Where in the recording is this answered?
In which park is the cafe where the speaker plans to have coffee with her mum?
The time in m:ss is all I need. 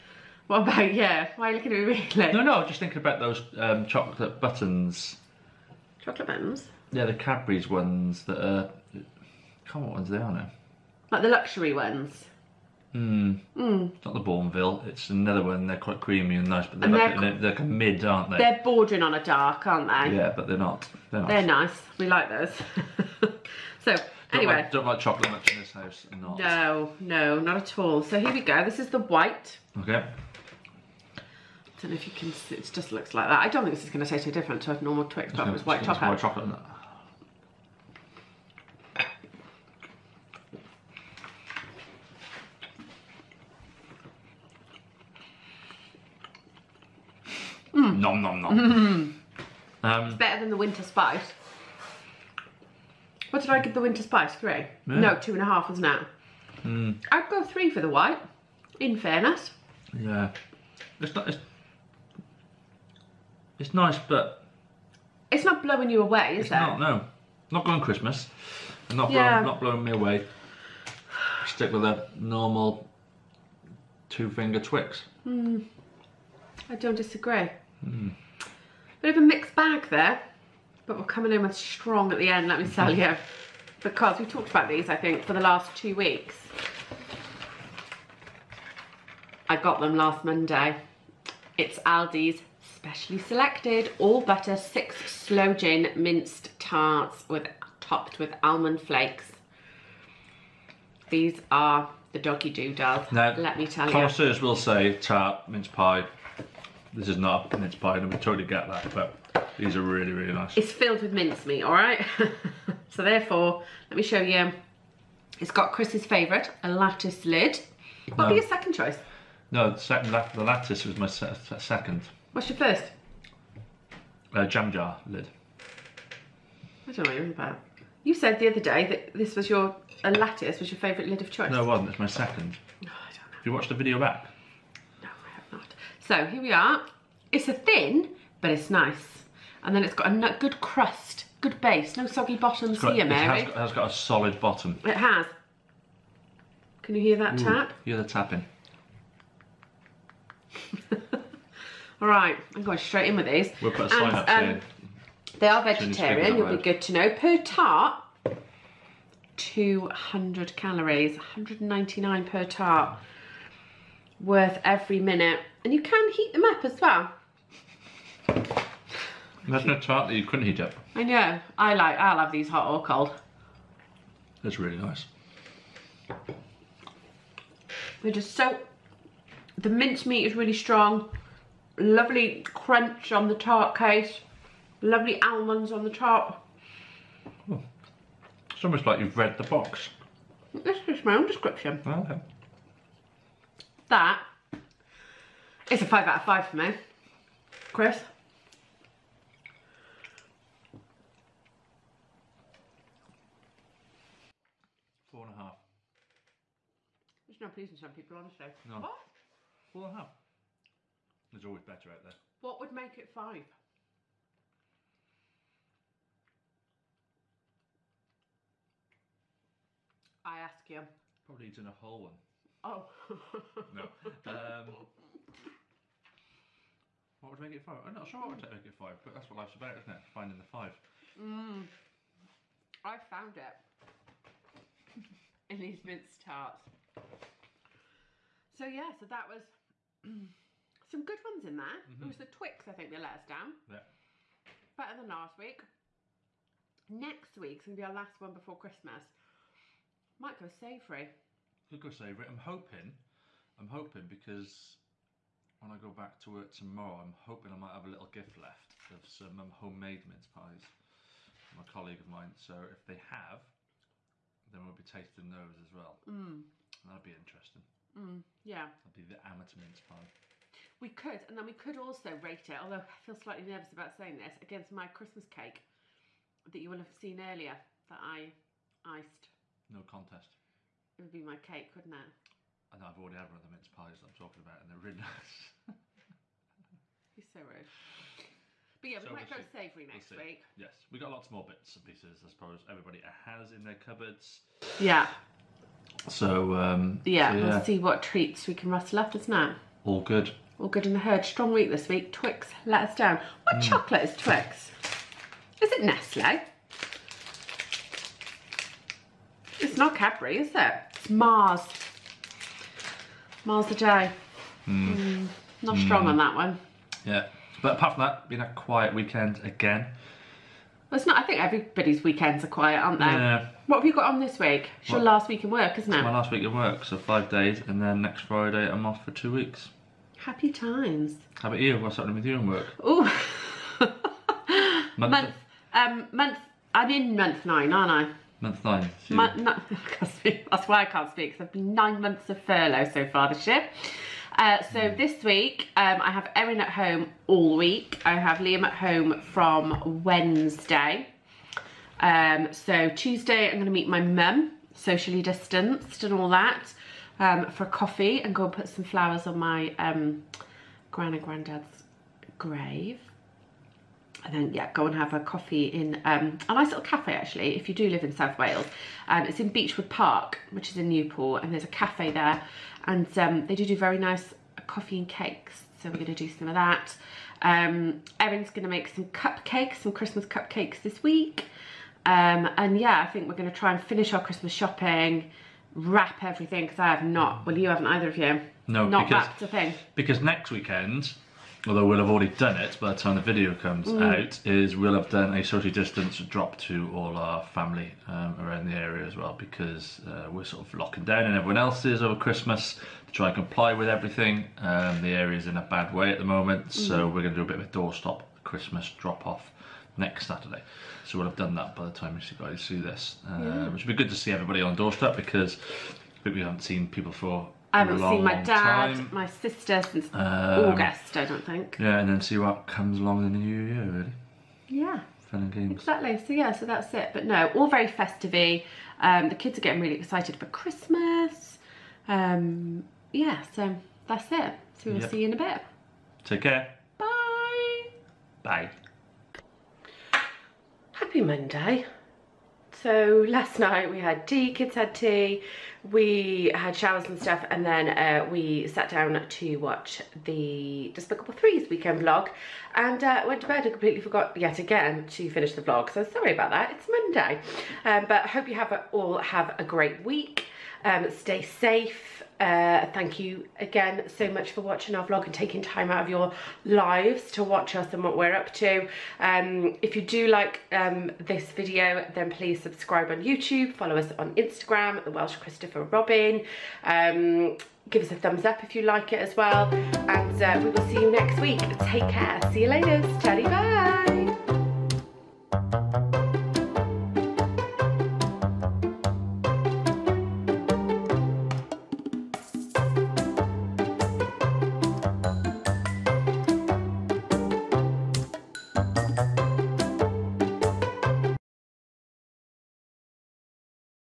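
6:09.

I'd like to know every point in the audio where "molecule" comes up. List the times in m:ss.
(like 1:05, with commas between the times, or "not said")
not said.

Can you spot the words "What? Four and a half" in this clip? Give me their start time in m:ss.
3:28.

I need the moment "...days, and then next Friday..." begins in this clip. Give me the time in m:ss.
5:27.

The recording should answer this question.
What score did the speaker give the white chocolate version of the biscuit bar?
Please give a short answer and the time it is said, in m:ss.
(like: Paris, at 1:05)
3, at 0:57.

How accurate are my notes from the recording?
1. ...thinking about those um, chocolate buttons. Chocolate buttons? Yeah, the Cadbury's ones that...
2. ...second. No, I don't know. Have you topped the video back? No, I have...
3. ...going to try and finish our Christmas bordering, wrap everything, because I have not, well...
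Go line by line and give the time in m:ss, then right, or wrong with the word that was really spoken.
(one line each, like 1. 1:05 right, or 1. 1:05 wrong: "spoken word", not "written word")
1. 0:02 right
2. 2:12 wrong: "watched", not "topped"
3. 6:23 wrong: "shopping", not "bordering".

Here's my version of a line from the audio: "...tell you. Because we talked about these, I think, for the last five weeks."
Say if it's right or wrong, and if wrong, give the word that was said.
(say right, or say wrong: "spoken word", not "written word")
wrong: "two", not "five".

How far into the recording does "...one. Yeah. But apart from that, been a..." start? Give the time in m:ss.
5:16.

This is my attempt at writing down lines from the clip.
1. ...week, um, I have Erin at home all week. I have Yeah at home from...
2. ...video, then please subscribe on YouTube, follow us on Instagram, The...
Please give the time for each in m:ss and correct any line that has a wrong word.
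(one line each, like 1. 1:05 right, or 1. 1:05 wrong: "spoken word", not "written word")
1. 5:45 wrong: "Liam", not "Yeah"
2. 7:51 right.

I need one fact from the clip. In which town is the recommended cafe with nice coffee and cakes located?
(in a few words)
Newport.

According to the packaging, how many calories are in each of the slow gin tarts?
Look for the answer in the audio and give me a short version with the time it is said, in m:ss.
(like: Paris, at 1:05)
199, at 2:41.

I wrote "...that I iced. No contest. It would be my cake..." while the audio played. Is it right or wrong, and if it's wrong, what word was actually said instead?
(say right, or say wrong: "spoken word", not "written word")
right.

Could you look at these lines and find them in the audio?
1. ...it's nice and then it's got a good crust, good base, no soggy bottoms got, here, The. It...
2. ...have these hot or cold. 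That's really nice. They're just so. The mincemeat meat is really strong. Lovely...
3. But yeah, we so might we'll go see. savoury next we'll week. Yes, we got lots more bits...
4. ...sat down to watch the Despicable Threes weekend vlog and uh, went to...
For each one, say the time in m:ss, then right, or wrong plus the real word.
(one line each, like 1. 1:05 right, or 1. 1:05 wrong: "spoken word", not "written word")
1. 2:18 wrong: "Mary", not "The"
2. 2:52 right
3. 4:48 right
4. 7:28 right.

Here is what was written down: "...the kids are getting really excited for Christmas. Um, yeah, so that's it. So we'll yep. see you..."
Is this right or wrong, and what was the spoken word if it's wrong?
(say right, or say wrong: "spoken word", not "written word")
right.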